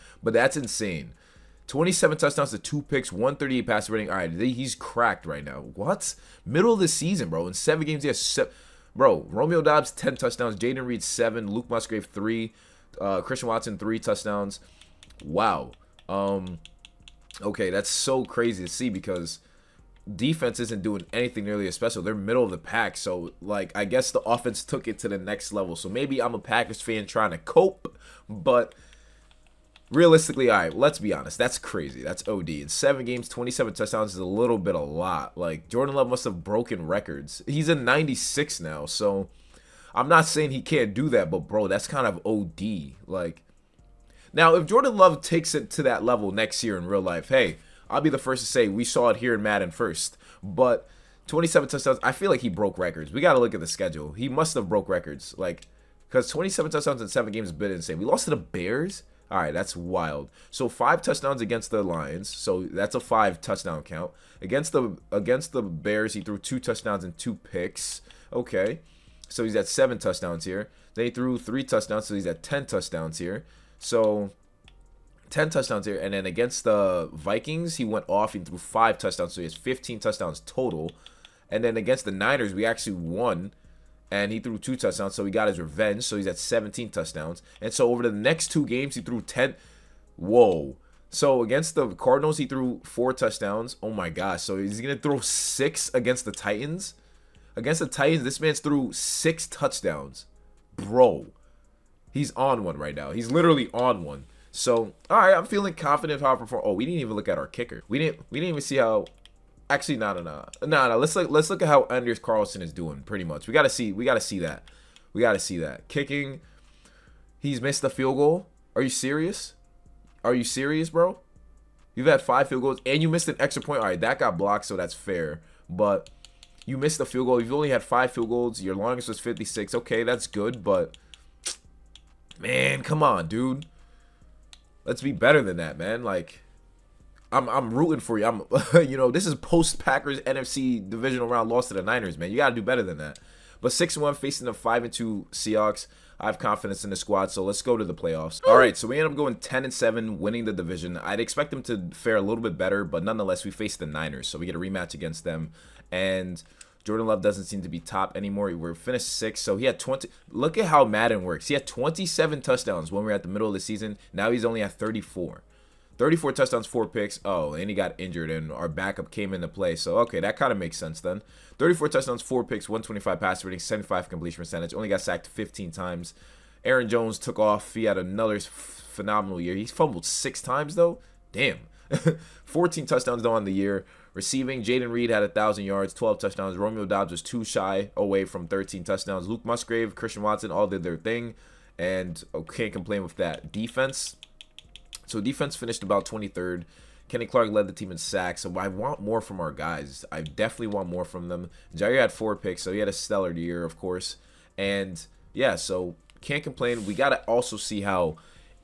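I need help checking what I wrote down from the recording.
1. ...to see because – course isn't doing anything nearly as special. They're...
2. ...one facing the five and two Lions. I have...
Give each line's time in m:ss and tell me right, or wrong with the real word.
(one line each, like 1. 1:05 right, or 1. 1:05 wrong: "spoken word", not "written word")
1. 0:18 wrong: "defense", not "course"
2. 2:23 wrong: "Seahawks", not "Lions".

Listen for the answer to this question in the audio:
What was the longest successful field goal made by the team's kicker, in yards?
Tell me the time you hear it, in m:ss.
2:09.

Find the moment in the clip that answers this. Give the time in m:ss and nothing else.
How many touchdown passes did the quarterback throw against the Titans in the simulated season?
1:38.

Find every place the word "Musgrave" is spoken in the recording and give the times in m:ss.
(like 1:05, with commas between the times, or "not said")
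0:11, 3:09.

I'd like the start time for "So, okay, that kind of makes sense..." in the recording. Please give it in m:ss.
2:49.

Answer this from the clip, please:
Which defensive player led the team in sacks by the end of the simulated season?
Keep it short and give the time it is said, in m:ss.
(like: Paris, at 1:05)
Kenny Clark, at 3:17.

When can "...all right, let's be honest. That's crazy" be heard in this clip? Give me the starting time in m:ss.
0:30.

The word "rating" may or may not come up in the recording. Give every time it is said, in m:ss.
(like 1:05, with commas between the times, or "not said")
0:03, 2:53.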